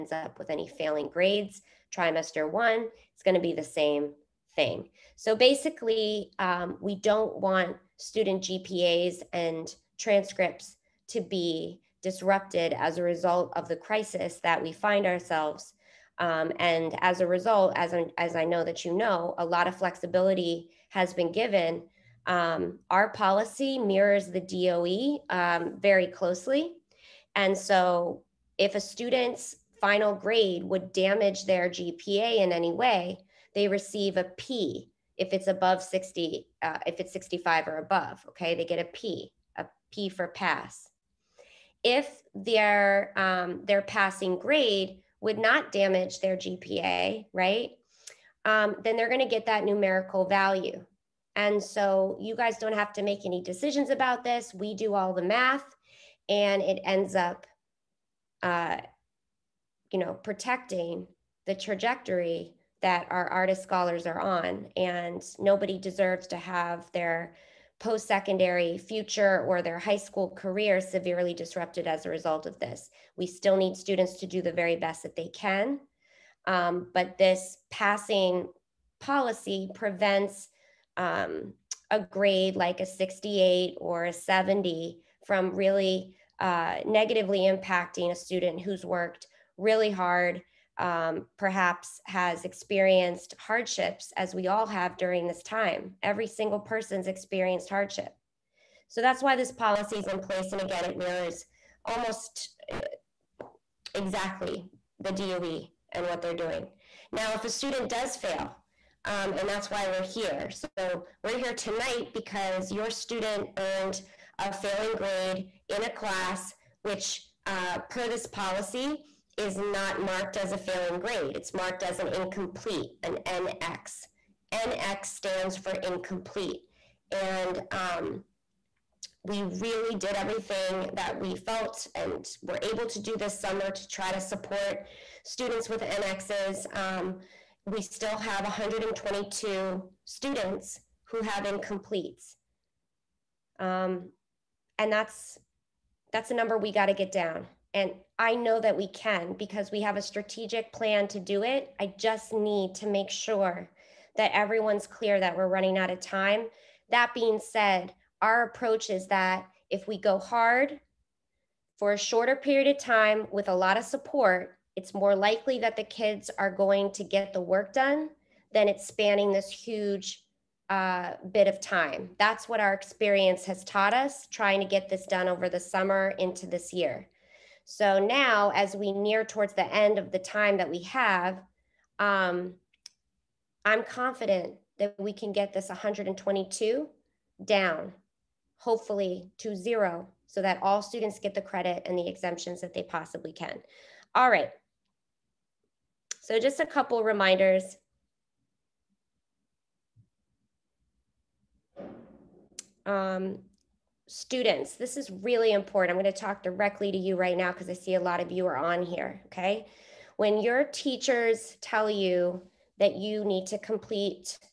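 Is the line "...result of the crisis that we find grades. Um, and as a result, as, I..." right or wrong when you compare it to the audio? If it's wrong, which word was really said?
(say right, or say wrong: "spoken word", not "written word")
wrong: "ourselves", not "grades".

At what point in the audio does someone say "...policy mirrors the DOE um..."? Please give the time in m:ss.
0:23.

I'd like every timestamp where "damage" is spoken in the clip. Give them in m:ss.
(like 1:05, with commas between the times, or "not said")
0:30, 0:45.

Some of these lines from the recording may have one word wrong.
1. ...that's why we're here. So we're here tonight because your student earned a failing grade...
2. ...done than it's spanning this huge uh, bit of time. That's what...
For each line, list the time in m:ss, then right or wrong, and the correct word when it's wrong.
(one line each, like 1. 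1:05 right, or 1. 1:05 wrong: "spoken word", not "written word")
1. 1:49 right
2. 2:47 right.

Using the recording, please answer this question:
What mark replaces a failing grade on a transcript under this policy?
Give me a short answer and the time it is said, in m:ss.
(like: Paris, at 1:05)
NX, at 2:03.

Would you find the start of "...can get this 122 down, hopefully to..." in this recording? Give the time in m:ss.
3:05.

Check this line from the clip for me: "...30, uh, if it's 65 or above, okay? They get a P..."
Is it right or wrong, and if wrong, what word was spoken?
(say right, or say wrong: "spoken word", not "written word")
wrong: "60", not "30".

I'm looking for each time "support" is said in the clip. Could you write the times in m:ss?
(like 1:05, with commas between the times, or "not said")
2:14, 2:43.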